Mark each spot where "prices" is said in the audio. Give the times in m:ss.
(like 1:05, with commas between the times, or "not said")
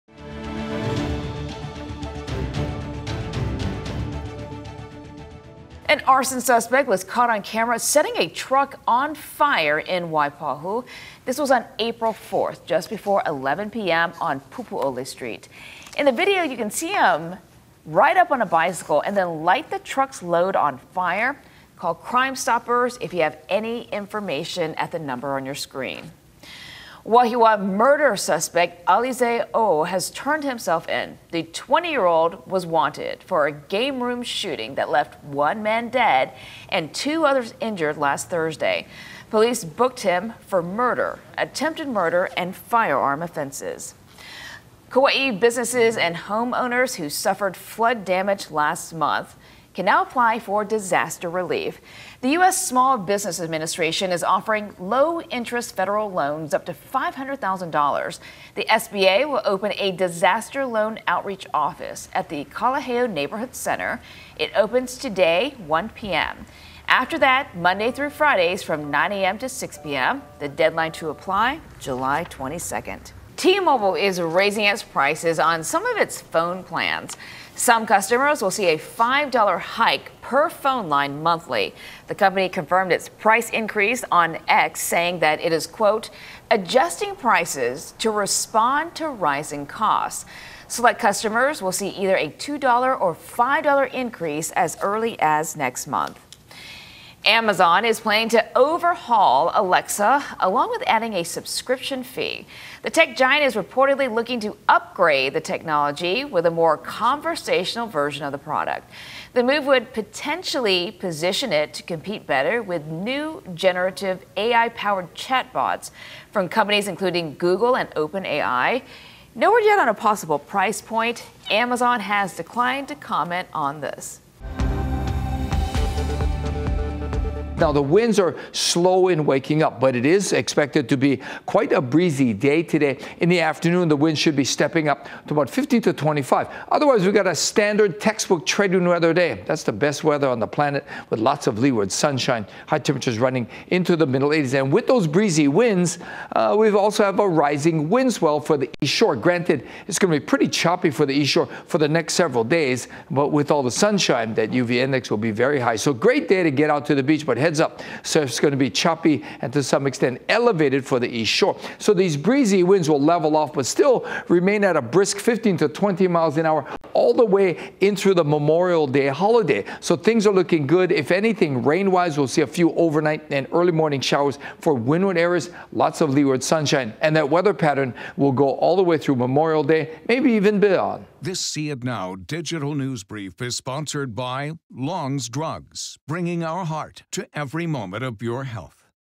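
1:14, 1:23, 1:27, 2:00.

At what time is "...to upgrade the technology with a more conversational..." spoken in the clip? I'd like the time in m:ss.
1:44.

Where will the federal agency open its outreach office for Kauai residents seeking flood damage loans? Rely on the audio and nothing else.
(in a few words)
Kalaheo Neighborhood Center.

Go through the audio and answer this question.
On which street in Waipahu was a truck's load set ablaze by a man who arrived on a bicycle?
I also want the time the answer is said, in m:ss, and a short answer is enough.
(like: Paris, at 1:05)
Pupu'ole Street, at 0:14.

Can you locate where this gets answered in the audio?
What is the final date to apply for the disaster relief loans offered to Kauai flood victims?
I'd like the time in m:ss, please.
1:11.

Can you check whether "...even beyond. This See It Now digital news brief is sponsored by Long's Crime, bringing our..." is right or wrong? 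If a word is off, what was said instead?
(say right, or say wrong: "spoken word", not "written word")
wrong: "Drugs", not "Crime".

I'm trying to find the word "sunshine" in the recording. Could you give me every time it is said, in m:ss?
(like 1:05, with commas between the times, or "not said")
2:21, 2:33, 2:56.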